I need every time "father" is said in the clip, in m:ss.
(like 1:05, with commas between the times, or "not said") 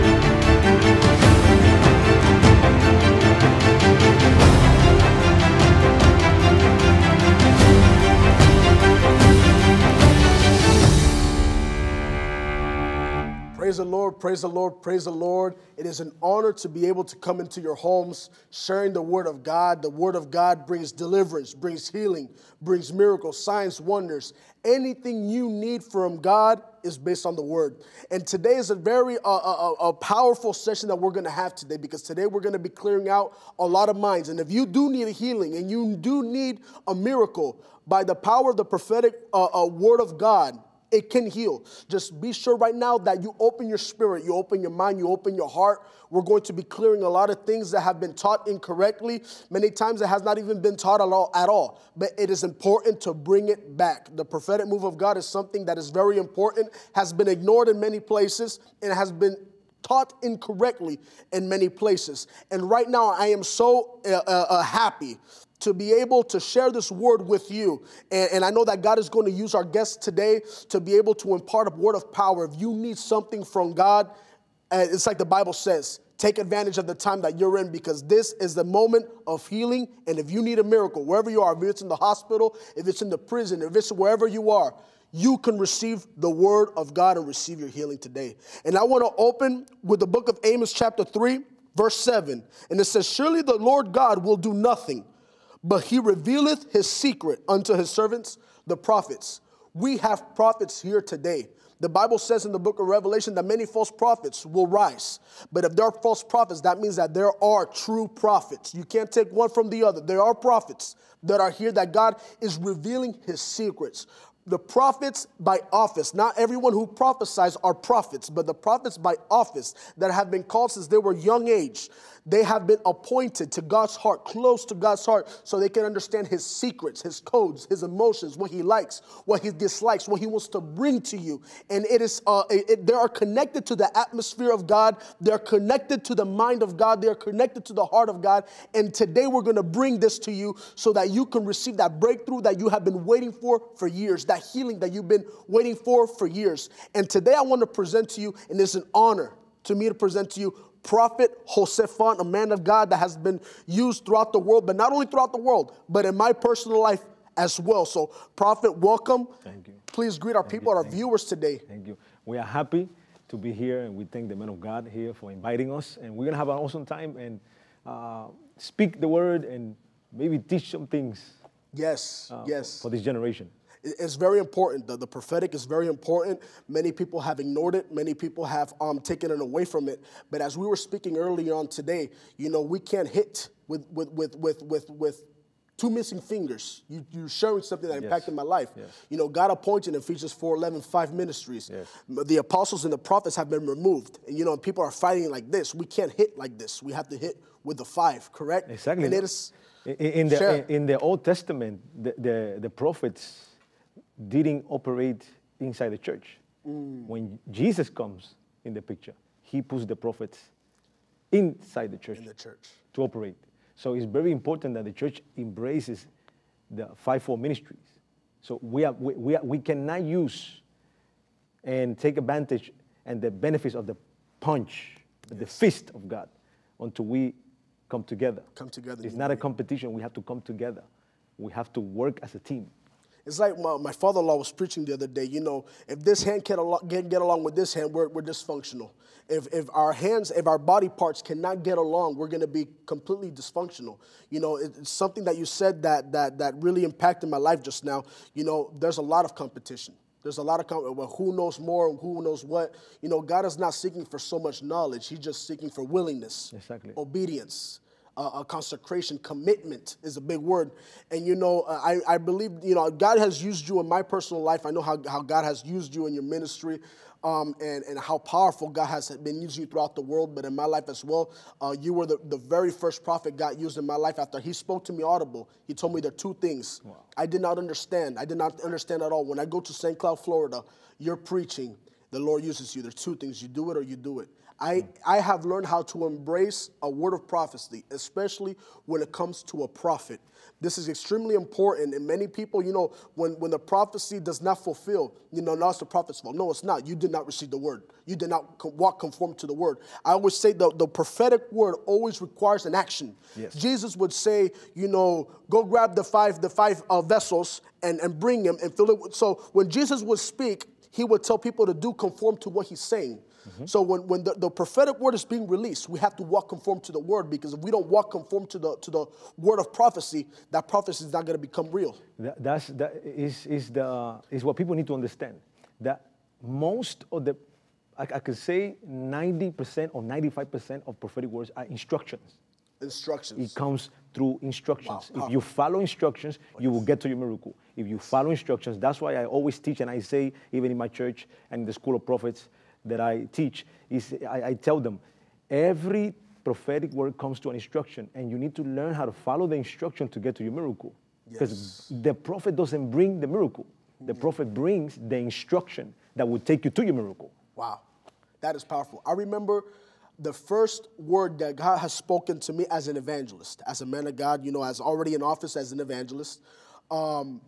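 3:53.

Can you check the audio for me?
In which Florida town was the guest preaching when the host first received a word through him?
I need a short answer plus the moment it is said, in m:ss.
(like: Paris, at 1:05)
St. Cloud, at 4:39.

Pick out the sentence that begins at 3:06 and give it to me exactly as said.
You, you're sharing something that yes.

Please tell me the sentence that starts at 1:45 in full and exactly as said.
But if there are false prophets, that means that there are true prophets.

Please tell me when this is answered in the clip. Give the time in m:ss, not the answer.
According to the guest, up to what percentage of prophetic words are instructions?
5:30.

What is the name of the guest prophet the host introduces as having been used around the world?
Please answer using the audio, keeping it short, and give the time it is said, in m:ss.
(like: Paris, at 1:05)
Jose Font, at 2:31.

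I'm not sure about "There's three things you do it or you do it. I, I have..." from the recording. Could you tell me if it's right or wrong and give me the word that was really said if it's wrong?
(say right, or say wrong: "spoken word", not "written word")
wrong: "two", not "three".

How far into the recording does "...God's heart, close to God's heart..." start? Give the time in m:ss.
2:03.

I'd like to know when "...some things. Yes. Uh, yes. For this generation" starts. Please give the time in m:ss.
2:50.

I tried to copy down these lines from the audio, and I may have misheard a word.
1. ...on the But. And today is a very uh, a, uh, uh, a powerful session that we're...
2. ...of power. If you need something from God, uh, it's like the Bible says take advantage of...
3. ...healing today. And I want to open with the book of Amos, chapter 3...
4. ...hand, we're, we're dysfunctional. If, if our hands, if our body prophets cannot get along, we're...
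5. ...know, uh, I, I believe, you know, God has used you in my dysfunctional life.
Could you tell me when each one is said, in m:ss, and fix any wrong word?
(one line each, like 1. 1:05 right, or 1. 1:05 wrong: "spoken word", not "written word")
1. 0:27 wrong: "Word", not "But"
2. 1:11 right
3. 1:27 right
4. 3:57 wrong: "parts", not "prophets"
5. 4:21 wrong: "personal", not "dysfunctional".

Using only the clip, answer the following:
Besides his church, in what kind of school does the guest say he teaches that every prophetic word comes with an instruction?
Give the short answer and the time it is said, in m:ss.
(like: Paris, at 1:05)
school of prophets, at 5:41.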